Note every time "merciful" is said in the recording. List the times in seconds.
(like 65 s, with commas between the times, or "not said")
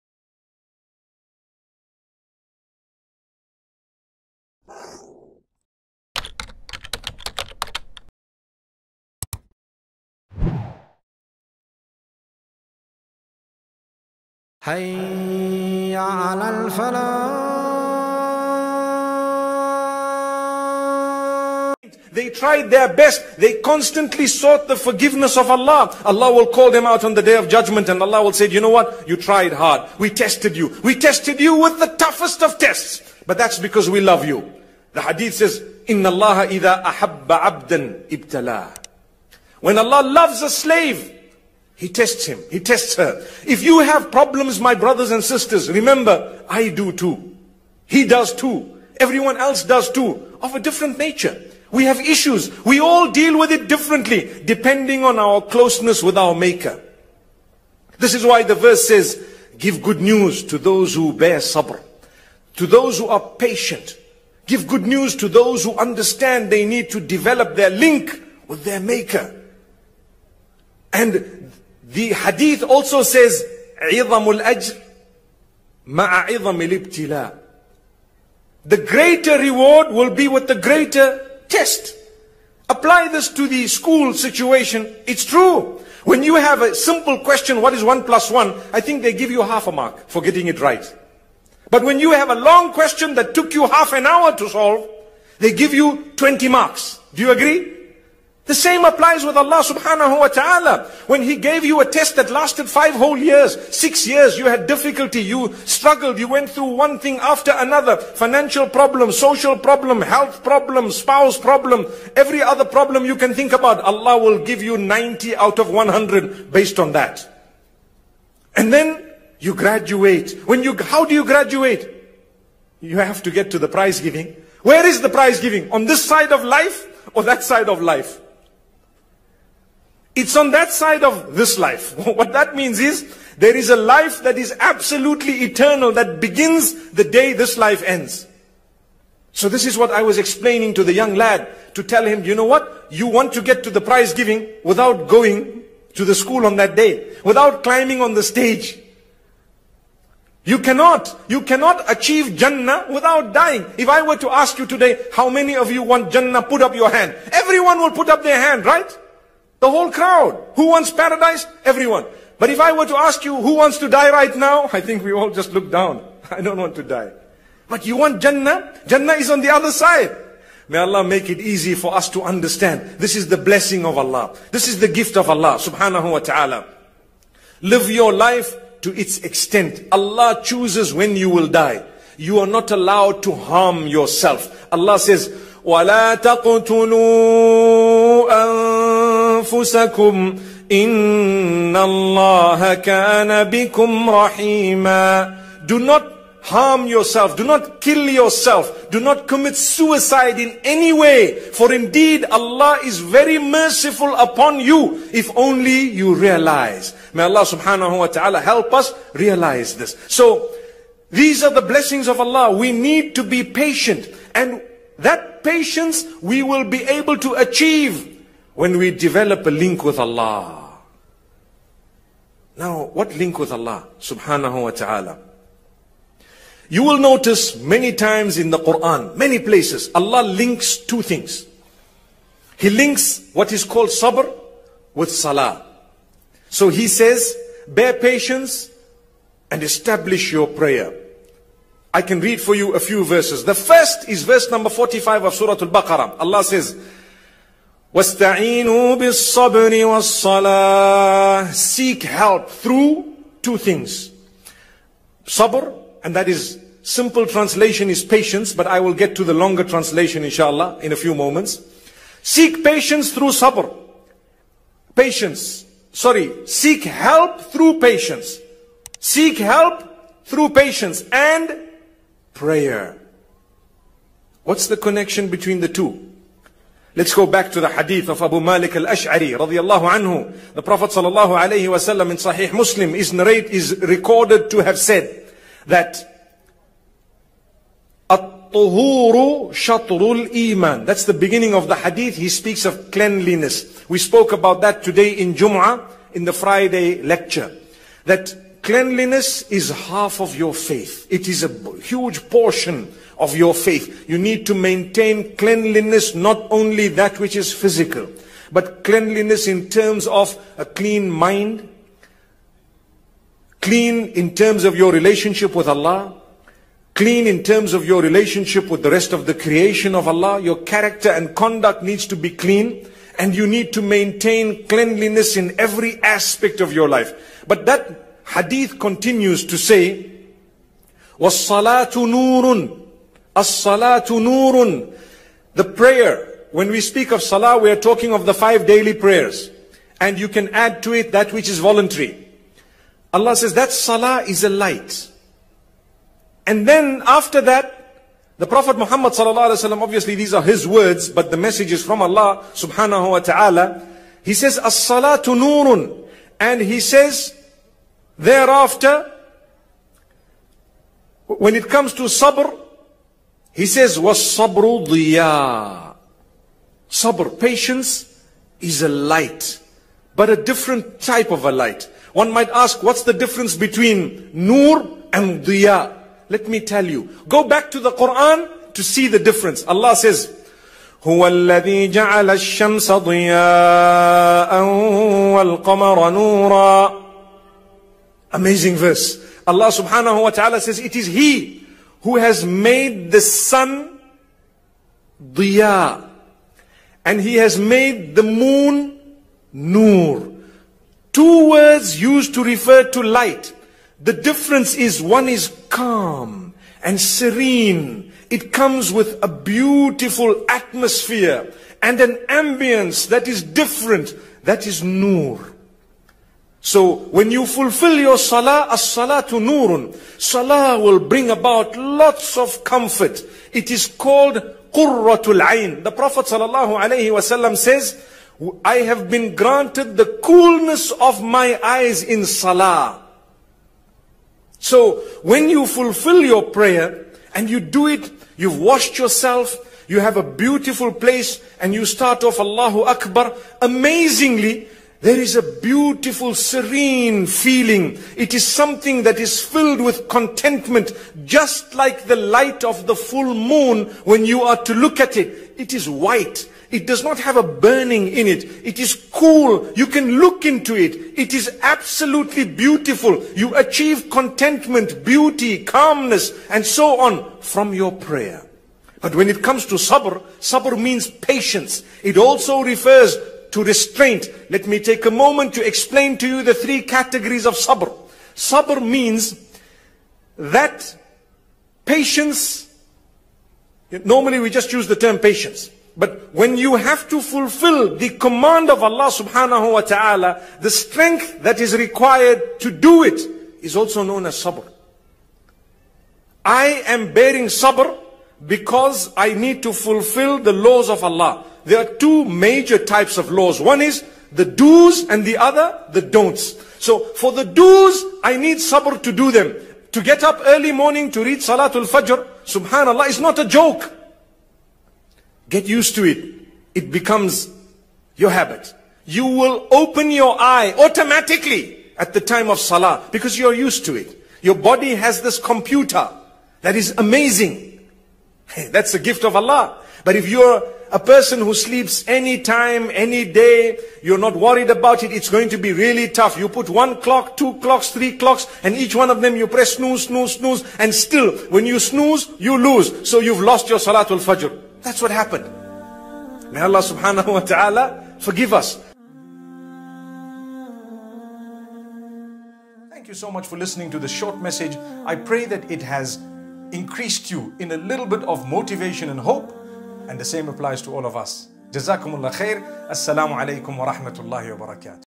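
203 s.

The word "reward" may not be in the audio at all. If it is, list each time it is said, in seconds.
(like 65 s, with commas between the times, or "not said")
79 s.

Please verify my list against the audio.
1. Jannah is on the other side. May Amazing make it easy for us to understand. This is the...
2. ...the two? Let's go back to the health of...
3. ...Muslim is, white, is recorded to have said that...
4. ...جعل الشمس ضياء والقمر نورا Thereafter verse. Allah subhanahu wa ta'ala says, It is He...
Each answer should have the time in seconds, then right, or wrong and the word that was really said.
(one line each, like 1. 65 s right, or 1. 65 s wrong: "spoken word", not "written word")
1. 168 s wrong: "Allah", not "Amazing"
2. 275 s wrong: "hadith", not "health"
3. 282 s wrong: "narrate", not "white"
4. 381 s wrong: "Amazing", not "Thereafter".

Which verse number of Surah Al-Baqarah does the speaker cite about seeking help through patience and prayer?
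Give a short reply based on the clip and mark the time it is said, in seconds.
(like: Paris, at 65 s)
45, at 244 s.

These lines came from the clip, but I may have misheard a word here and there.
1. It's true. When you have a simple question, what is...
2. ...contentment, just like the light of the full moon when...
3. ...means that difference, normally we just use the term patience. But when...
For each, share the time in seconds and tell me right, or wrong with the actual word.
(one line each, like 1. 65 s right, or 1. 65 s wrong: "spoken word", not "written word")
1. 85 s right
2. 450 s right
3. 478 s wrong: "patience", not "difference".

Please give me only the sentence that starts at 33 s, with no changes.
But that's because we love you.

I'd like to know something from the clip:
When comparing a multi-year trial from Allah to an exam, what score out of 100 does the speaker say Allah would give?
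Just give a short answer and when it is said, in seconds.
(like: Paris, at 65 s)
90, at 114 s.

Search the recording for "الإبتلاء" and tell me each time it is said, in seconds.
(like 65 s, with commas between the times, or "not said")
76 s.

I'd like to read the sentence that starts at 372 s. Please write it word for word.
One might ask, what's the difference between nur and diya?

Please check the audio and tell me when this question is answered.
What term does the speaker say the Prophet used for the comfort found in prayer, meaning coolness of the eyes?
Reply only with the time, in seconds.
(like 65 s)
424 s.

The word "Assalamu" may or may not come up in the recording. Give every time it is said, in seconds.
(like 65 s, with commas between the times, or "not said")
562 s.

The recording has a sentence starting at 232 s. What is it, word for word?
He links what is called sabr with salah.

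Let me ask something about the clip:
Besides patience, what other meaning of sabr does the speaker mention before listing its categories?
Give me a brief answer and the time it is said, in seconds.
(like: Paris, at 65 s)
restraint, at 473 s.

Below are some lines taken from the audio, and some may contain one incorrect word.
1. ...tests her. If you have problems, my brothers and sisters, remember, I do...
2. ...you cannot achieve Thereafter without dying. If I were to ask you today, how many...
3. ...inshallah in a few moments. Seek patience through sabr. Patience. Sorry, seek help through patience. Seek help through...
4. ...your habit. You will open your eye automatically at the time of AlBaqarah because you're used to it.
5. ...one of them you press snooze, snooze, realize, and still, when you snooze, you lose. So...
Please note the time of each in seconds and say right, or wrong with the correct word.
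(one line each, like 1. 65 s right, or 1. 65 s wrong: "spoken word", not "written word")
1. 42 s right
2. 151 s wrong: "Jannah", not "Thereafter"
3. 260 s right
4. 518 s wrong: "Salah", not "AlBaqarah"
5. 538 s wrong: "snooze", not "realize".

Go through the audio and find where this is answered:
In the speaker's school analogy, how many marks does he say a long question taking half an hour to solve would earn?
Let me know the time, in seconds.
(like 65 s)
96 s.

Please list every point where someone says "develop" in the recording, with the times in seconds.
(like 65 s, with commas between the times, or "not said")
66 s, 218 s.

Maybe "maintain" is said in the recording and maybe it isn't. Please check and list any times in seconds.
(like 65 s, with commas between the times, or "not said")
304 s, 323 s.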